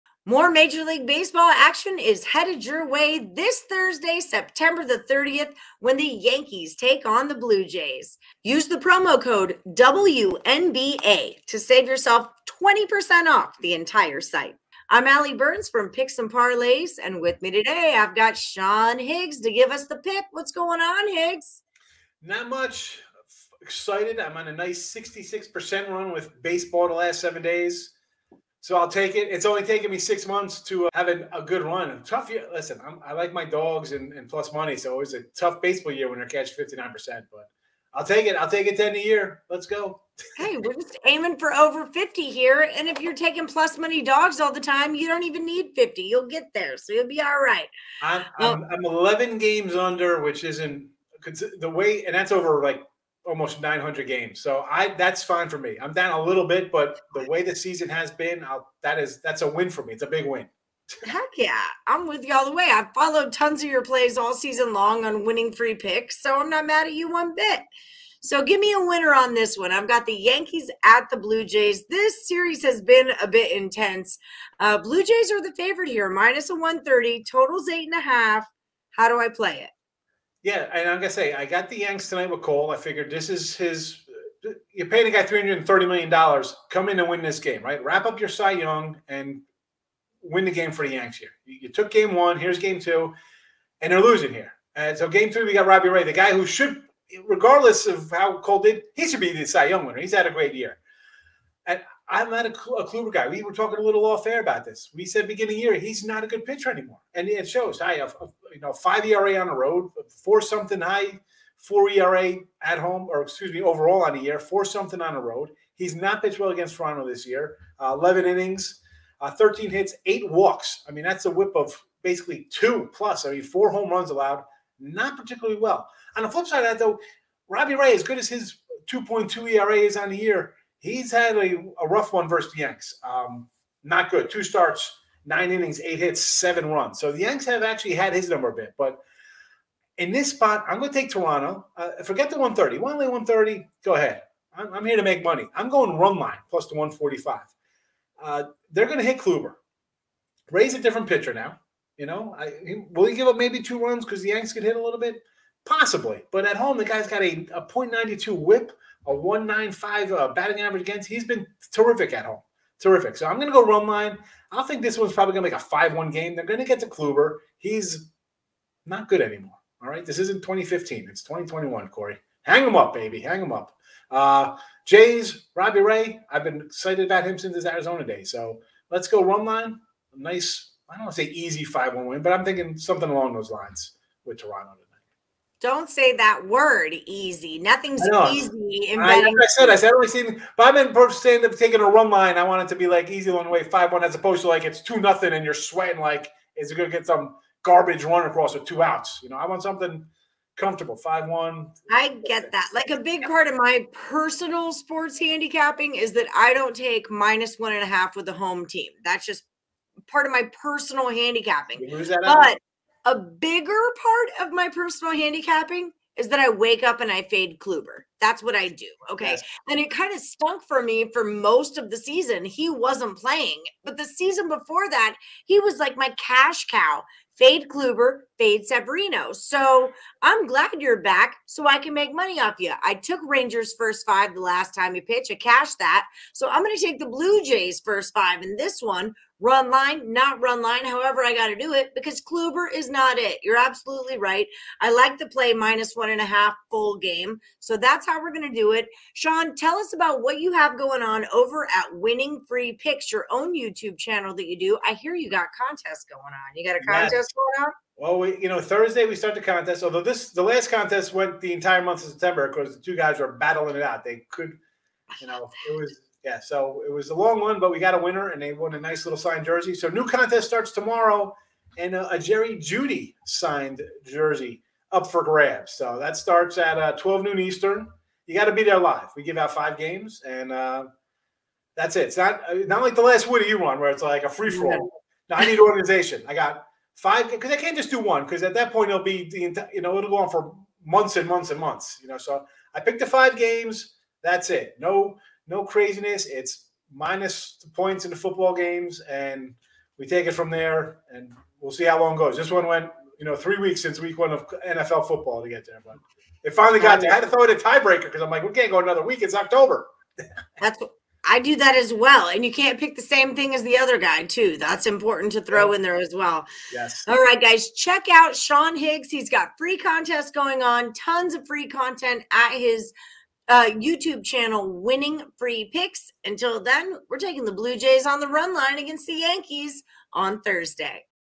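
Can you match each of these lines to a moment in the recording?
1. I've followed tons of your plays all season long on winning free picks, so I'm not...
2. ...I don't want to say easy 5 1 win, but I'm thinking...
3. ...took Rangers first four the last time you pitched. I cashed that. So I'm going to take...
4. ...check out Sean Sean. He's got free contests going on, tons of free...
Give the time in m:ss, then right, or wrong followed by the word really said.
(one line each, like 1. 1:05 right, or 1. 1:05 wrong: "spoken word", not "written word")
1. 1:02 right
2. 3:00 right
3. 3:52 wrong: "five", not "four"
4. 5:17 wrong: "Higgs", not "Sean".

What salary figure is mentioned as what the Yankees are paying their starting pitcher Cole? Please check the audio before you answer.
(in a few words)
330 million dollars.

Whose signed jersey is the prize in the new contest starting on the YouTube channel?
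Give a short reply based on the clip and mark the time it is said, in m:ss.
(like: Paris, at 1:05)
Jerry Jeudy, at 4:32.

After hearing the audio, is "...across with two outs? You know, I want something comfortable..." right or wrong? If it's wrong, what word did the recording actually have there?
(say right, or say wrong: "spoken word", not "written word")
right.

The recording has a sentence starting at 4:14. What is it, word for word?
I hear you got contests going on.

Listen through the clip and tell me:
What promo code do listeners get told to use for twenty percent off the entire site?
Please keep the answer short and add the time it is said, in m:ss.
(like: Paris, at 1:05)
WNBA, at 0:09.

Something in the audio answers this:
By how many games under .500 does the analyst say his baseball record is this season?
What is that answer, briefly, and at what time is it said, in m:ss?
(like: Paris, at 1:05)
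11, at 0:48.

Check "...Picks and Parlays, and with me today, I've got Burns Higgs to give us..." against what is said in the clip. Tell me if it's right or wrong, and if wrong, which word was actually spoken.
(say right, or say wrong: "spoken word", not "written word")
wrong: "Sean", not "Burns".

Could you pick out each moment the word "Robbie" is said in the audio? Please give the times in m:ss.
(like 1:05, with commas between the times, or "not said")
1:35, 2:07, 2:55.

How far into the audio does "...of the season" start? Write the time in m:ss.
3:41.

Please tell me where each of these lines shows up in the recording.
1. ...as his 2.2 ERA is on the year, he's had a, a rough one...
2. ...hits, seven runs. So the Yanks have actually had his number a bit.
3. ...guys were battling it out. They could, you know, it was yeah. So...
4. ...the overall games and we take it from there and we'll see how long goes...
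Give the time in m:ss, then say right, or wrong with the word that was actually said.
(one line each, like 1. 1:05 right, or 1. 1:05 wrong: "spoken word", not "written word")
1. 2:08 right
2. 2:15 right
3. 4:22 right
4. 4:58 wrong: "football", not "overall".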